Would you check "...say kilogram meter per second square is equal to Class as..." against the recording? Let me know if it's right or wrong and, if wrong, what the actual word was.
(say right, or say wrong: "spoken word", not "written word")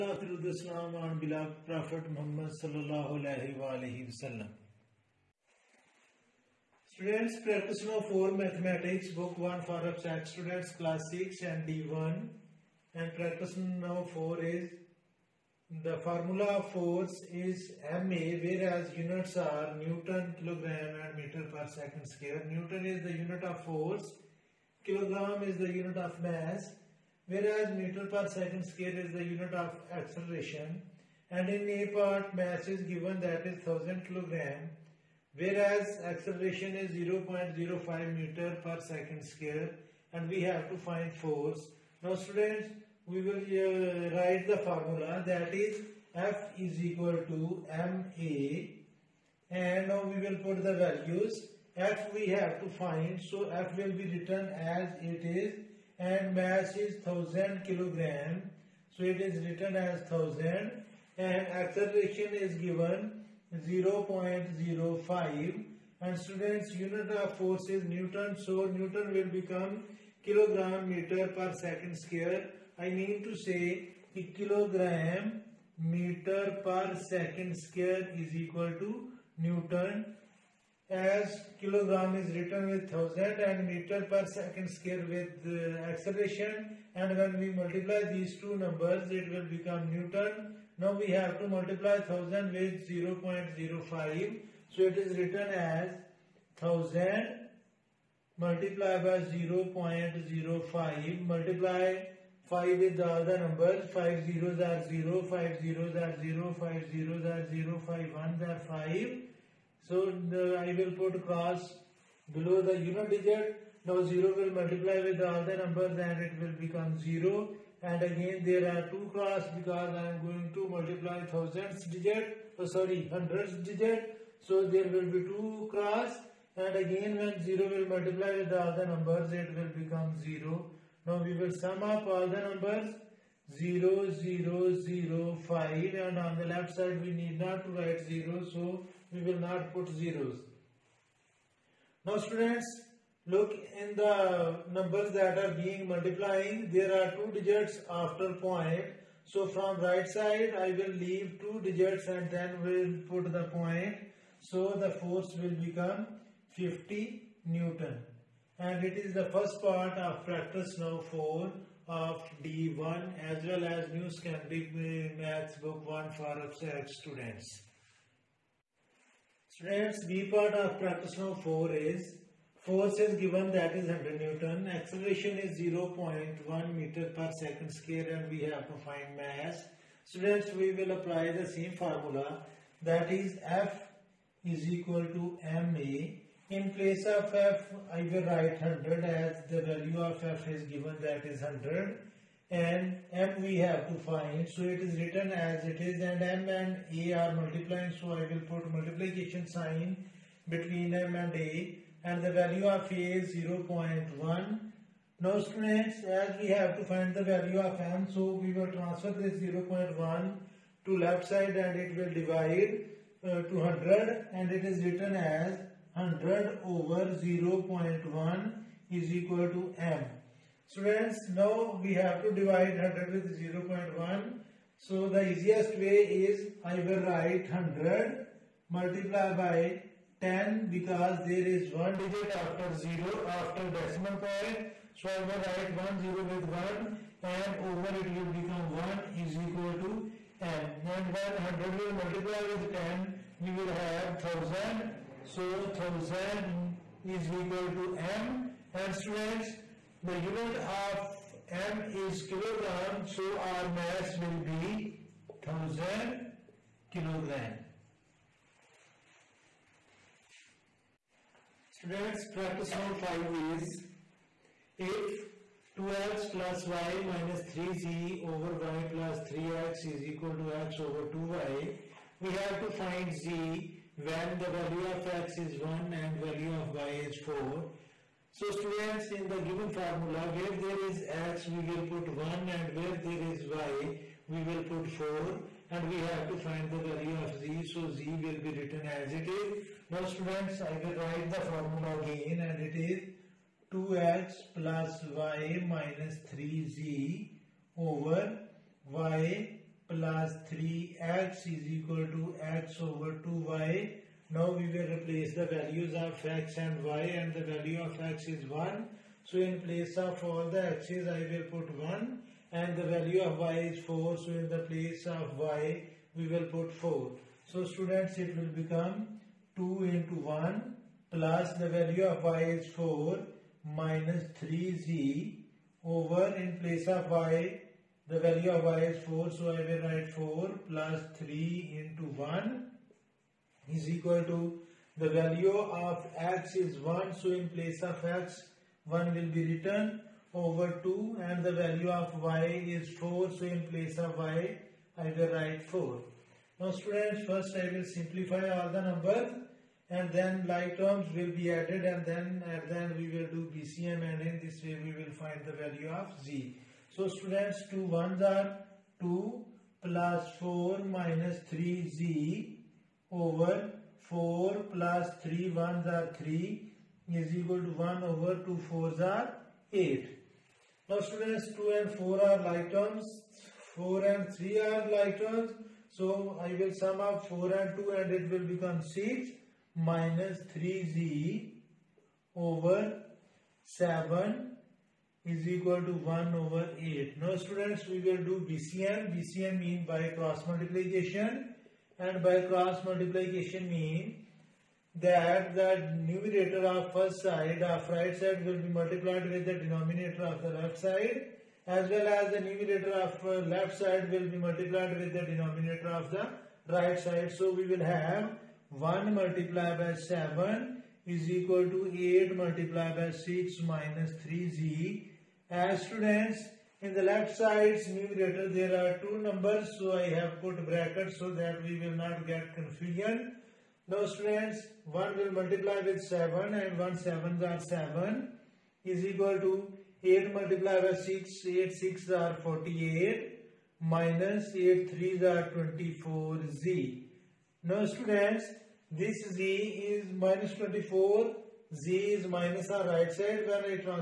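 wrong: "Newton", not "Class".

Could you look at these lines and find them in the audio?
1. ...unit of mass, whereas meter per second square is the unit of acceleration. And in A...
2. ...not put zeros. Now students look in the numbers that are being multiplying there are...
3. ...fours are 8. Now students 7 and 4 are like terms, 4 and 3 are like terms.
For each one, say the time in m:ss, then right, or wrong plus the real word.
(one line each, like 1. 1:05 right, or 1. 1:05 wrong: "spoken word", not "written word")
1. 0:25 right
2. 2:19 right
3. 6:08 wrong: "2", not "7".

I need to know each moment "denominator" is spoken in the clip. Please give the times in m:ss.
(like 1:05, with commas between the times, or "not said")
6:39, 6:45.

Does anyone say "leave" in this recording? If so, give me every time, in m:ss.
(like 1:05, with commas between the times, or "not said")
2:30.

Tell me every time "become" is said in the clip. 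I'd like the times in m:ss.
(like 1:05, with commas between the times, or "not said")
1:09, 1:29, 1:56, 2:09, 2:35, 3:58, 5:18, 6:18.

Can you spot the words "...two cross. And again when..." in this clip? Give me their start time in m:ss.
2:05.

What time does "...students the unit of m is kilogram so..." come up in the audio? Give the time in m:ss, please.
4:08.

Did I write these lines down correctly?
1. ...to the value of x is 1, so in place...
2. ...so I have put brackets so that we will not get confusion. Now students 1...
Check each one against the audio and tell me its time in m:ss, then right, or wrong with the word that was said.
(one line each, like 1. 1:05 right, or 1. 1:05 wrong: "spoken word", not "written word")
1. 5:34 right
2. 6:59 right.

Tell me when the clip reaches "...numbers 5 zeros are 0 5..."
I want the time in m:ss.
1:43.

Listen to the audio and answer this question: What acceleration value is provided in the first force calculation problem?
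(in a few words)
0.05 meter per second square.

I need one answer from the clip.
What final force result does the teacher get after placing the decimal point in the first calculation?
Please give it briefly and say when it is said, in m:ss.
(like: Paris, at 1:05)
50 Newton, at 2:36.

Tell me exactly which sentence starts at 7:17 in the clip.
Now students this z is minus 24 z is minus on right side.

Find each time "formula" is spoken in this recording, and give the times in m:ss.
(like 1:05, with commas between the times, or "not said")
0:16, 0:44, 3:01, 4:39, 4:51.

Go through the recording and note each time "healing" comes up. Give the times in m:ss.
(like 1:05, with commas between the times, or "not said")
not said.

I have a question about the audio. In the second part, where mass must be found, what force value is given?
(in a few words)
100 Newton.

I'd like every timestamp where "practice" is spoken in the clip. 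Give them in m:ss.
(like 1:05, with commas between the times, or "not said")
0:07, 0:13, 2:40, 2:50, 4:22.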